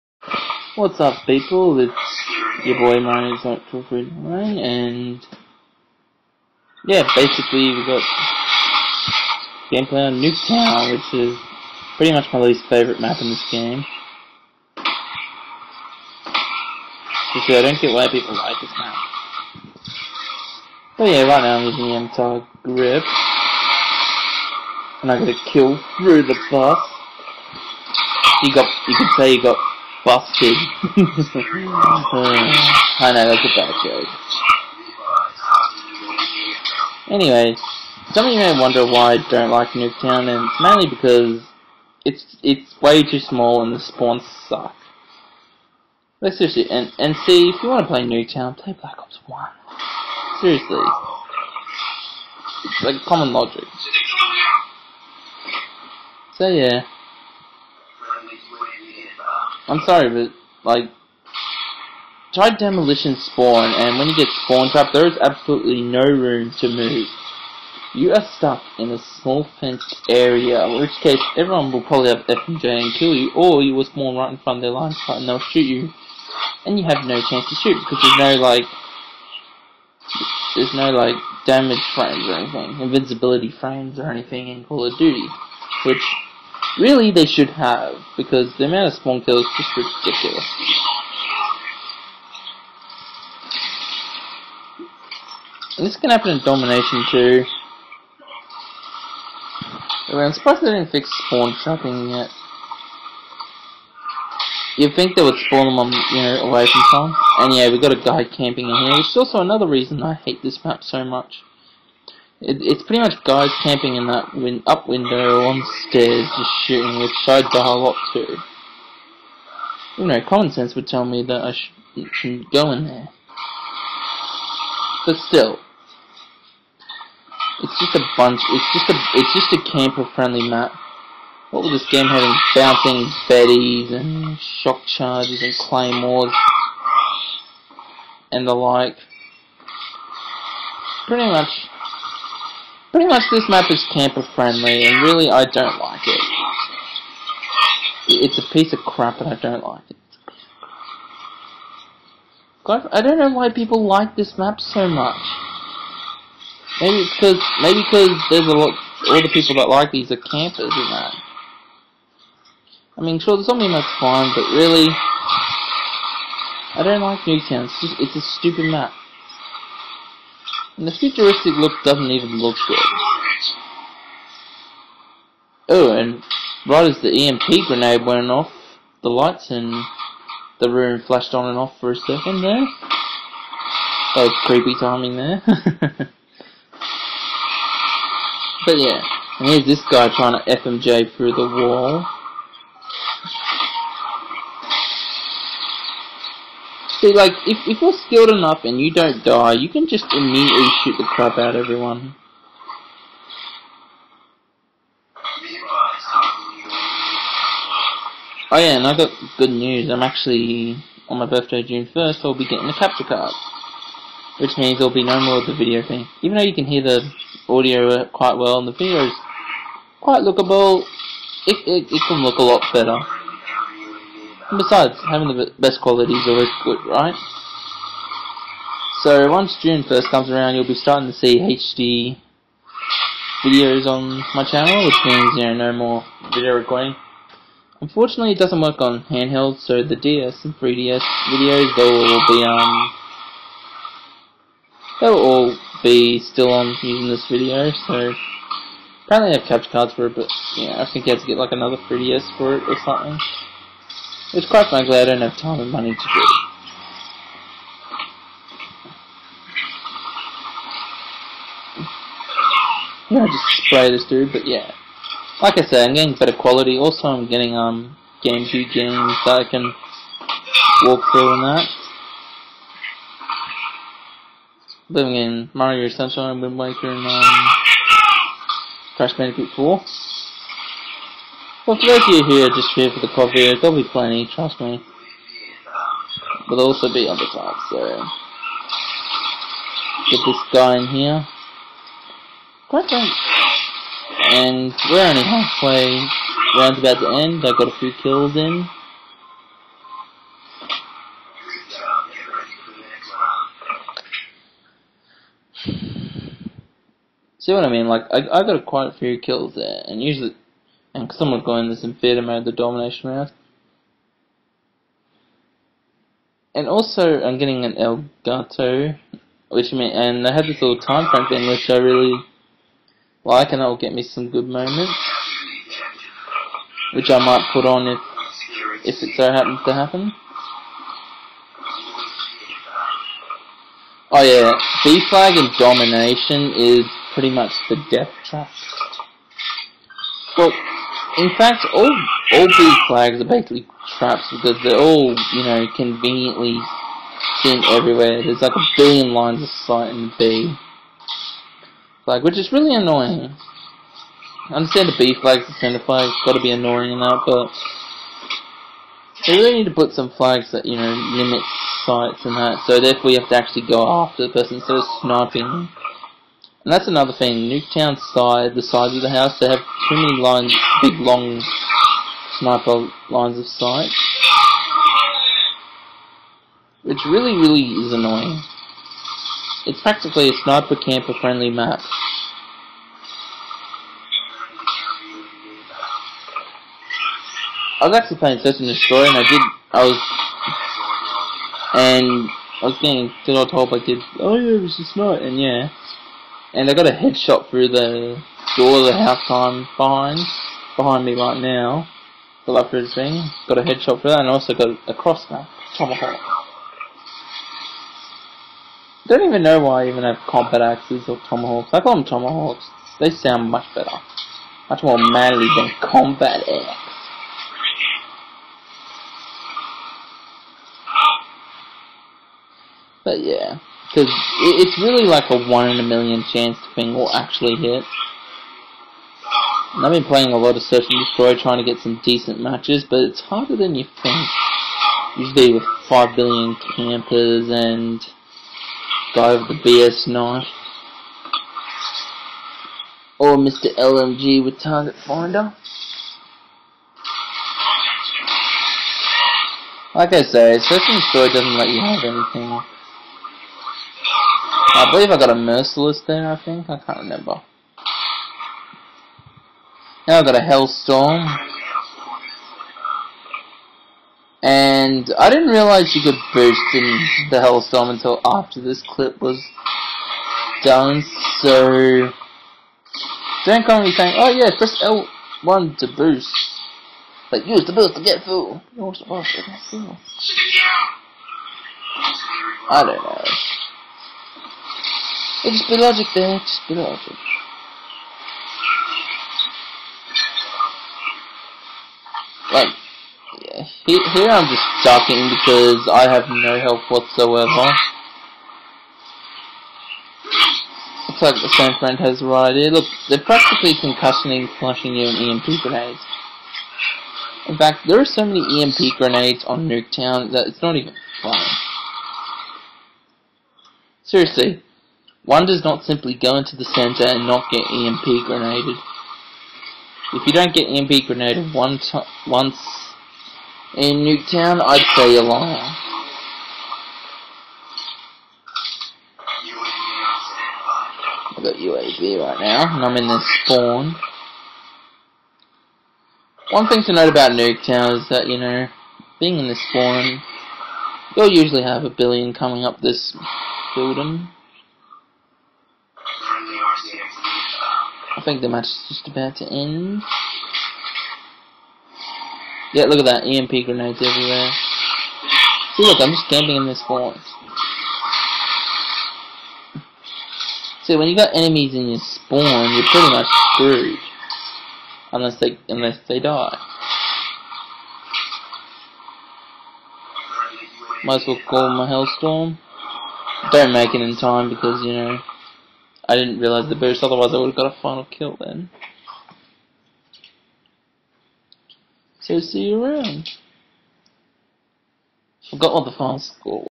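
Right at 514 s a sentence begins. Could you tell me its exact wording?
Seriously, one does not simply go into the center and not get EMP grenaded.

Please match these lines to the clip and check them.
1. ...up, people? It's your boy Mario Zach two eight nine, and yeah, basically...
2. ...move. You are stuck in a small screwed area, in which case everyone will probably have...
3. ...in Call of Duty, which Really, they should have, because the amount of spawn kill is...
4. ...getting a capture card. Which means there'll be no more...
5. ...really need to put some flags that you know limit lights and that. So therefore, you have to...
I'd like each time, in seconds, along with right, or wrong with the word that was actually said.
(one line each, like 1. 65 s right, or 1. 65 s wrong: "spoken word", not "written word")
1. 1 s wrong: "three", not "eight"
2. 66 s wrong: "fenced", not "screwed"
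3. 84 s right
4. 212 s right
5. 359 s wrong: "sights", not "lights".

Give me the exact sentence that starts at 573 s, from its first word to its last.
Don't make it in time because, you know, I didn't realize the boost, otherwise I would have got a final kill then.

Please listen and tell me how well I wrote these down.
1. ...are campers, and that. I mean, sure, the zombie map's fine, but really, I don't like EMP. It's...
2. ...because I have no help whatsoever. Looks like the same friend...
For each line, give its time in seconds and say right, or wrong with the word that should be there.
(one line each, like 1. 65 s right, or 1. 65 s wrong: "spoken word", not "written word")
1. 160 s wrong: "Nuketown", not "EMP"
2. 495 s right.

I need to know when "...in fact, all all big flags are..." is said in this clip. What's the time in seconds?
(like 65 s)
341 s.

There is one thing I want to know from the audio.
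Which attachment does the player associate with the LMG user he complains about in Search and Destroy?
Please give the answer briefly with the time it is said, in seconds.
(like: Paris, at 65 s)
Target Finder, at 444 s.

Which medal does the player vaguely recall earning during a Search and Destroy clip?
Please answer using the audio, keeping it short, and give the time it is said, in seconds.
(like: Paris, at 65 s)
Merciless, at 455 s.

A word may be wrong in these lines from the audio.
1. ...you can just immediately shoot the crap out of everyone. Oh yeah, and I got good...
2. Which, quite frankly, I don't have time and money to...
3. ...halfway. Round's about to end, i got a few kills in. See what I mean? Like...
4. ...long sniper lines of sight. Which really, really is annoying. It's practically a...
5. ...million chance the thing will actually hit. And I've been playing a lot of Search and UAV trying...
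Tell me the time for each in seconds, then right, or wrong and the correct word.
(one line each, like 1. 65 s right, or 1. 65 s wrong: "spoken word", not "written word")
1. 199 s right
2. 254 s right
3. 295 s right
4. 370 s right
5. 425 s wrong: "Destroy", not "UAV".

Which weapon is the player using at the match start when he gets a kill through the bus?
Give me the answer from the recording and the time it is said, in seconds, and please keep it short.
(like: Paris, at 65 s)
MTAR, at 22 s.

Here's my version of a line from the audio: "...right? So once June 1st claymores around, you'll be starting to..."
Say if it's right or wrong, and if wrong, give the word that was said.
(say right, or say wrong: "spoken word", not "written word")
wrong: "comes", not "claymores".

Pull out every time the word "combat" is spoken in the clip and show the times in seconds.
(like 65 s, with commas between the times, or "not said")
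410 s, 415 s.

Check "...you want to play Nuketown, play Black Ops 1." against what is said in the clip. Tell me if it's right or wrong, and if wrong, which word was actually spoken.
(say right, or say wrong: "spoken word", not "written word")
right.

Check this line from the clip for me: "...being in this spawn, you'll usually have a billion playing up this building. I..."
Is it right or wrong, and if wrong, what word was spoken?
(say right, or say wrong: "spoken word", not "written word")
wrong: "coming", not "playing".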